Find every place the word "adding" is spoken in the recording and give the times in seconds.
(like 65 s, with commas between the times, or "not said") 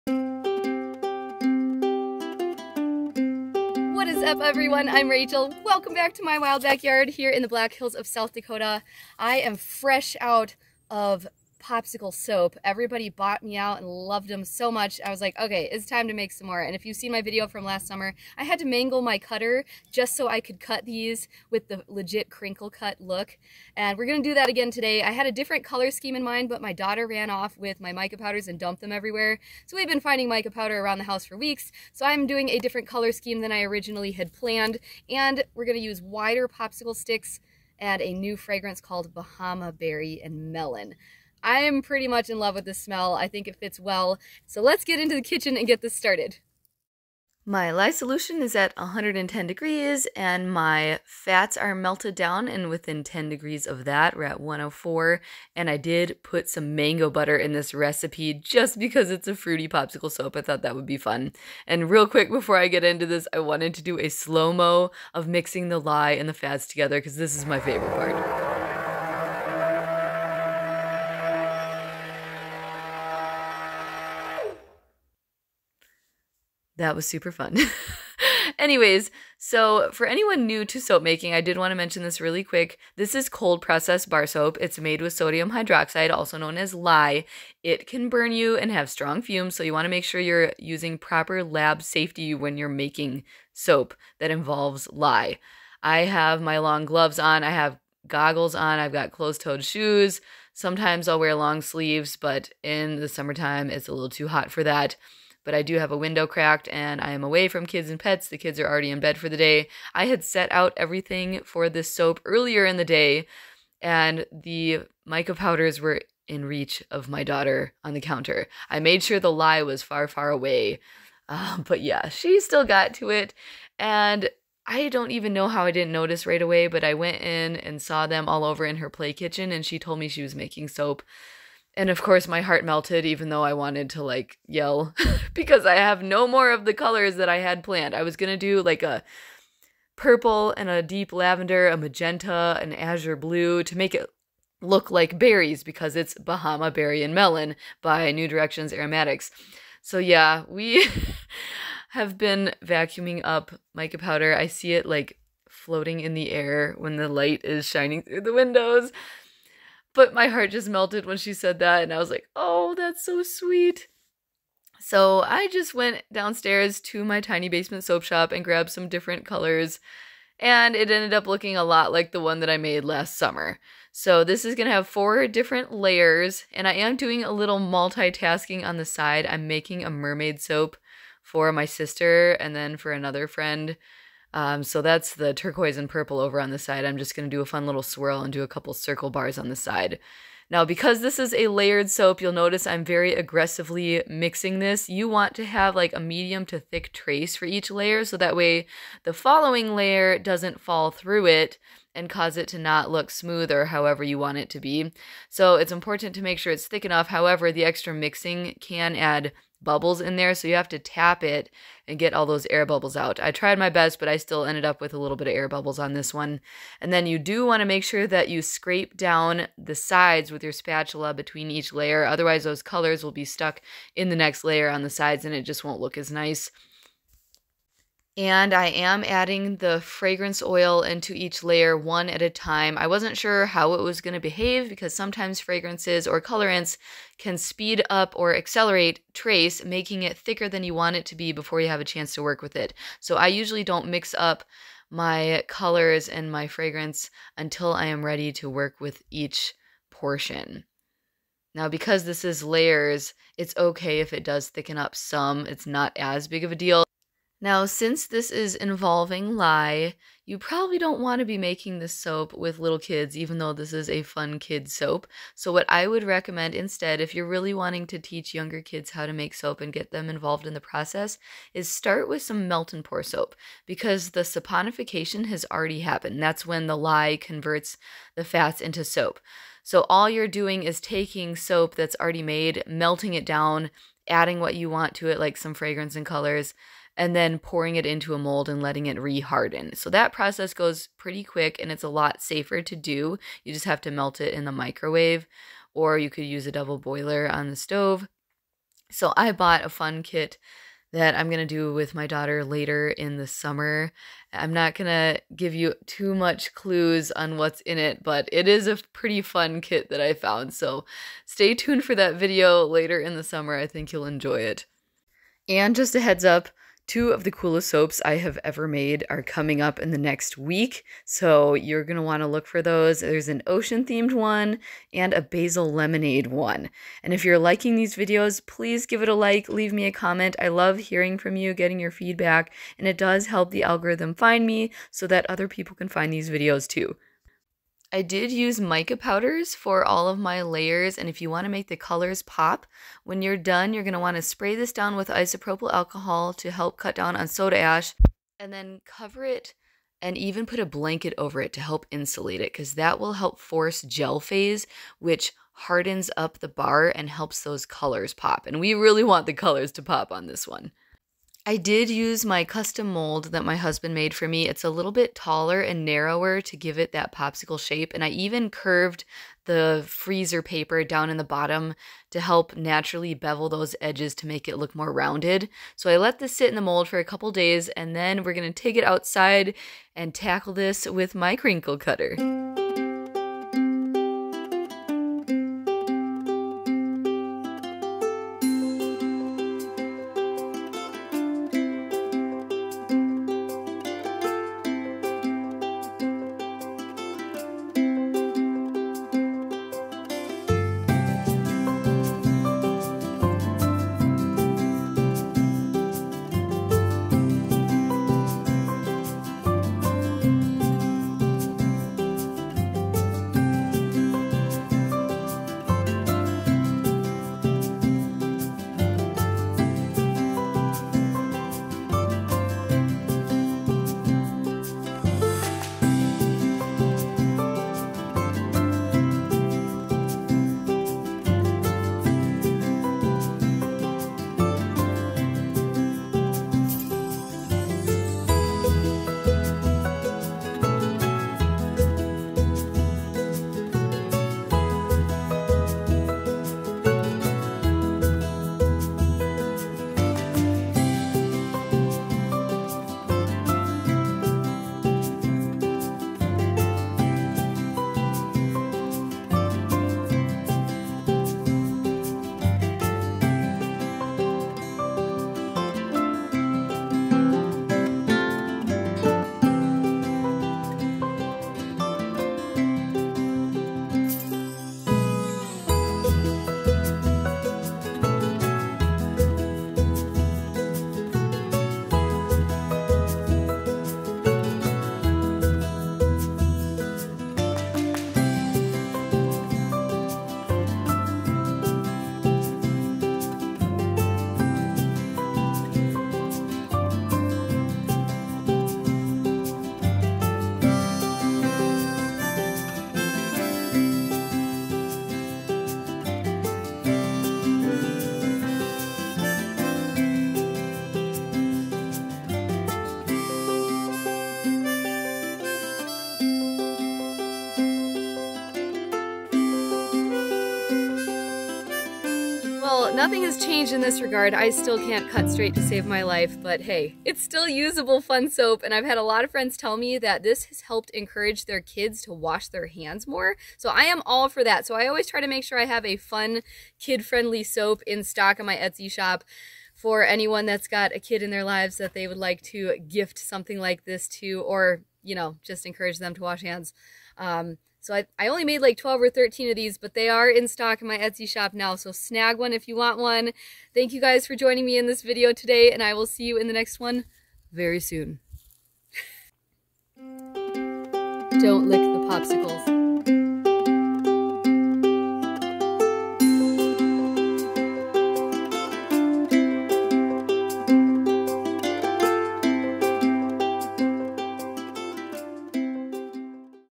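229 s, 284 s.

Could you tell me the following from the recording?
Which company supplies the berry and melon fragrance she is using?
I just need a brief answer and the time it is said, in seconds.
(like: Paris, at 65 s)
New Directions Aromatics, at 148 s.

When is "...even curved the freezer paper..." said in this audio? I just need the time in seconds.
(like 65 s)
368 s.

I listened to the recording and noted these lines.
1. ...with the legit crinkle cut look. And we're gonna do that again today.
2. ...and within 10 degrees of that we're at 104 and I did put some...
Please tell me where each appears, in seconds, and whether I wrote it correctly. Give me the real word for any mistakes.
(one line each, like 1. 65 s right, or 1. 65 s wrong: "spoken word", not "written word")
1. 21 s right
2. 52 s right.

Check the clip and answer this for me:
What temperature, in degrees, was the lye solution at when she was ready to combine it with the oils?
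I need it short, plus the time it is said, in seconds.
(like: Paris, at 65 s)
110, at 48 s.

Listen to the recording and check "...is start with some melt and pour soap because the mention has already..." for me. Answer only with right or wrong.
wrong.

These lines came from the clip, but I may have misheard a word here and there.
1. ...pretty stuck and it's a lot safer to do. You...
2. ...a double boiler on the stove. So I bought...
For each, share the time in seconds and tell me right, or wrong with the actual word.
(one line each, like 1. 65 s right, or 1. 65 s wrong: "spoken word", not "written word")
1. 290 s wrong: "quick", not "stuck"
2. 296 s right.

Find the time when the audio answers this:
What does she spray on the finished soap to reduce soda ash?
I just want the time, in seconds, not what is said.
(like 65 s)
345 s.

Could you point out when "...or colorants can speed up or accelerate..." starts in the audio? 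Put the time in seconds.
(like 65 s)
236 s.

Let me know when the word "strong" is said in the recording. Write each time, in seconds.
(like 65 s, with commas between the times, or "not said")
88 s.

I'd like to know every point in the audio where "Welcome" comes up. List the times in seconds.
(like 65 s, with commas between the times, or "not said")
5 s.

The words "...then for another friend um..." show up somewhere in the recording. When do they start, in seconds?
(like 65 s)
182 s.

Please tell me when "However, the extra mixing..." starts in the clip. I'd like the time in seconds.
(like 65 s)
207 s.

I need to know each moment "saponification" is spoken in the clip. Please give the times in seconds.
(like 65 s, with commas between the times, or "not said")
274 s.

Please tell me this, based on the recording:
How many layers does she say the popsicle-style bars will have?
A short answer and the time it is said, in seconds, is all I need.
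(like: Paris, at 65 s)
4, at 174 s.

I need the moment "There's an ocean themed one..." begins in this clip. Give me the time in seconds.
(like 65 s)
322 s.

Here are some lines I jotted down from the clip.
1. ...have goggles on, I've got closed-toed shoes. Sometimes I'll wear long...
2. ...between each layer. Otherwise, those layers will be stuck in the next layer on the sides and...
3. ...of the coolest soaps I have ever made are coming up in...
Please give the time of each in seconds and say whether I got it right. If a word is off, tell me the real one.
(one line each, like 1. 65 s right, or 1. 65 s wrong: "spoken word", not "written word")
1. 97 s right
2. 221 s wrong: "colors", not "layers"
3. 317 s right.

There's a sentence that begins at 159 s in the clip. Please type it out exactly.
But my heart just melted when she said that, and I was like, oh, that's so sweet.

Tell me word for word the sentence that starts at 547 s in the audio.
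Um, so I, I only made like 12 or 13 of these, but they are in stock in my Etsy shop now.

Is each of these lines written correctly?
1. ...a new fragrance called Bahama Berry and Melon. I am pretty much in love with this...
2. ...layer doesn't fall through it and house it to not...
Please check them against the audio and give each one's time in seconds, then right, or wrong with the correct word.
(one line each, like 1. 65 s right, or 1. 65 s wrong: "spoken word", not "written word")
1. 38 s right
2. 199 s wrong: "cause", not "house".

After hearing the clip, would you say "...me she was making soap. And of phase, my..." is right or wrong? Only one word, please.
wrong.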